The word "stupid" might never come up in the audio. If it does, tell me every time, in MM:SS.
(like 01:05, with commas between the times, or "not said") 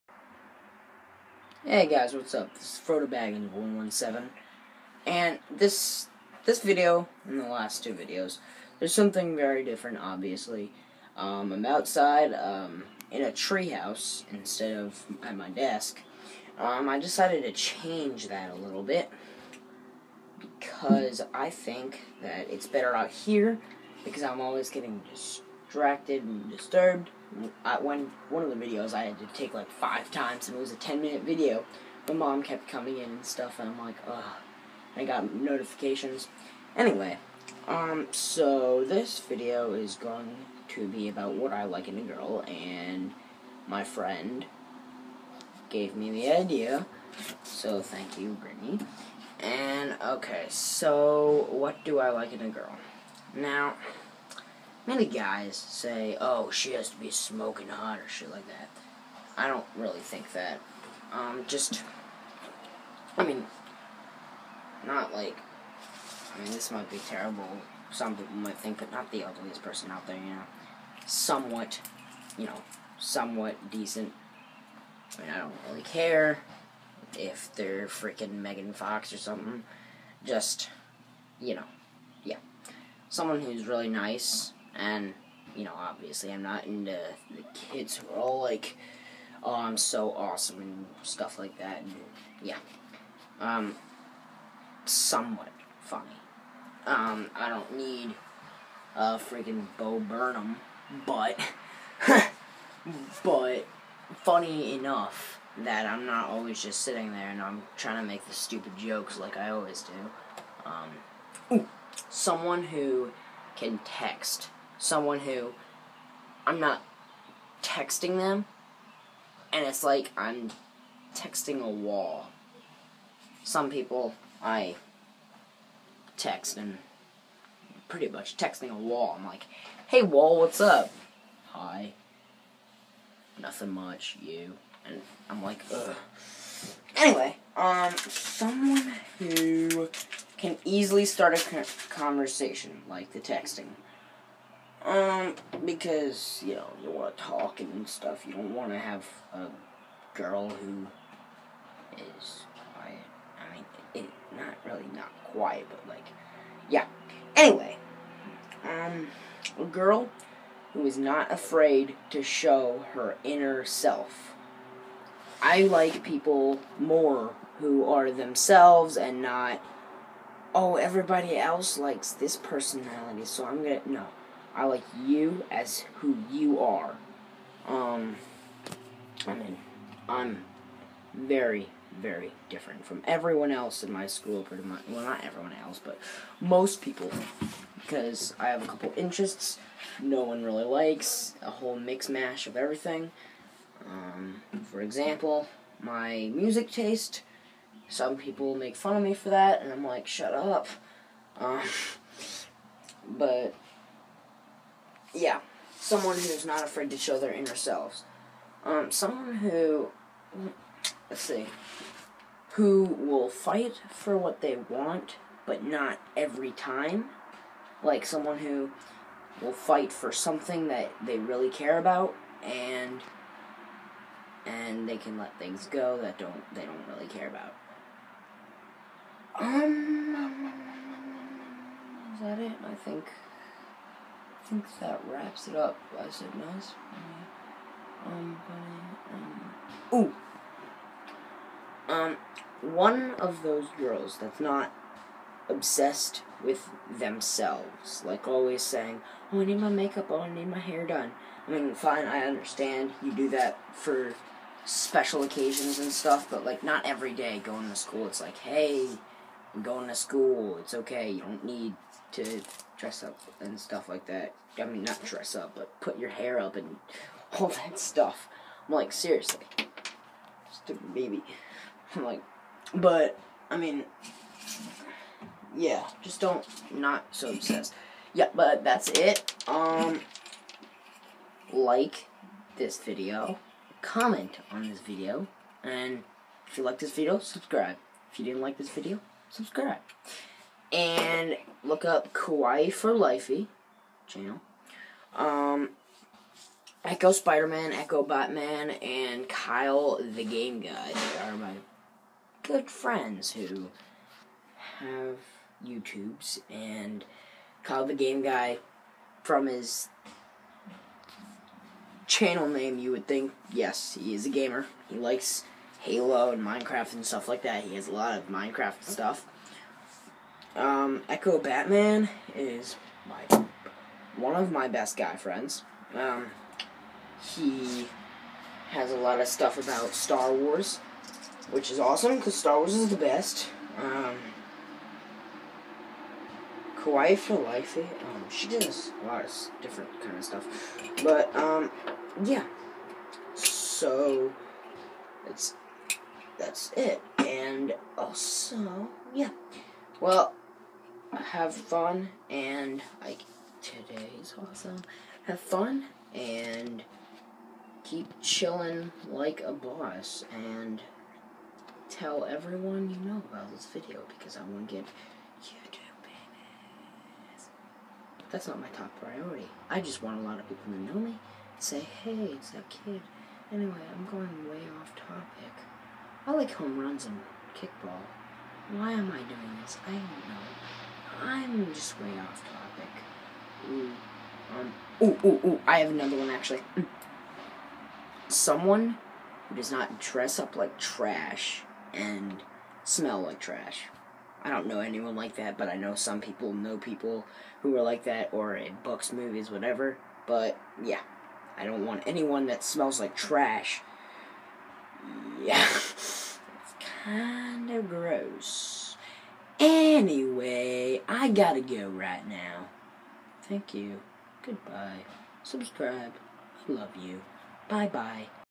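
01:48, 04:30.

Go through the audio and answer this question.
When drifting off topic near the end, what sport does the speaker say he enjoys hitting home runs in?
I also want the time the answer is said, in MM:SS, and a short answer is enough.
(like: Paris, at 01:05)
Kickball, at 06:17.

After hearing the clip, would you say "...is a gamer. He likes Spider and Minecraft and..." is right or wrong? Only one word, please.
wrong.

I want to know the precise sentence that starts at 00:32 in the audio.
My mom kept coming in and stuff, and I'm like, ugh.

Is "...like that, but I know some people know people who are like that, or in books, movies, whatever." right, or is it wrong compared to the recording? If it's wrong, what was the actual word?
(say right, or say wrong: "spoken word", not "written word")
right.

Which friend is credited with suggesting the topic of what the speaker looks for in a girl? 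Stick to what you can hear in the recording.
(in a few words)
Brittany.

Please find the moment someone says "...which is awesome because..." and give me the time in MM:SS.
05:31.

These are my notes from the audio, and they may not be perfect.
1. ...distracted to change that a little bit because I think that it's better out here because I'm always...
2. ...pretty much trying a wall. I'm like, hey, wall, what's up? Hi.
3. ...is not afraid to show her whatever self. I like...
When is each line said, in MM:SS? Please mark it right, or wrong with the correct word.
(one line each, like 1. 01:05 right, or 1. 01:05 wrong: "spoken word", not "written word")
1. 00:16 wrong: "decided", not "distracted"
2. 02:07 wrong: "texting", not "trying"
3. 02:40 wrong: "inner", not "whatever".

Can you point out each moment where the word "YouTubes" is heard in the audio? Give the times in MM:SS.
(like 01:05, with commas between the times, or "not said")
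05:05, 06:05.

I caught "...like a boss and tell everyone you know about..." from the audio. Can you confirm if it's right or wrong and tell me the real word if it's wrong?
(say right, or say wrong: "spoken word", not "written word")
right.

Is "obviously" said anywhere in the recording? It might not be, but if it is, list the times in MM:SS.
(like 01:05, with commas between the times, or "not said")
00:10, 01:25.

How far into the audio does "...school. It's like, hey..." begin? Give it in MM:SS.
04:17.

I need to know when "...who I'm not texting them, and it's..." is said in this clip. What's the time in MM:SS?
01:55.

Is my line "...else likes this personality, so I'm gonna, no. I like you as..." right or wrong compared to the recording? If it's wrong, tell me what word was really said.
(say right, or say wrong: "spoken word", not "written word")
right.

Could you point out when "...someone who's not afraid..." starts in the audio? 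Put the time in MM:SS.
03:25.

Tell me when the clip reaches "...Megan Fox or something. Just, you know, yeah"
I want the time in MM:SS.
01:18.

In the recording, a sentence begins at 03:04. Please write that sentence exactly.
Well, not everyone else, but most people.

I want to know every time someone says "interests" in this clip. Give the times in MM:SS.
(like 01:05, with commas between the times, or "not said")
03:08.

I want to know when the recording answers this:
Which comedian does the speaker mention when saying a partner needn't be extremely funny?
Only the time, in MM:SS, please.
01:39.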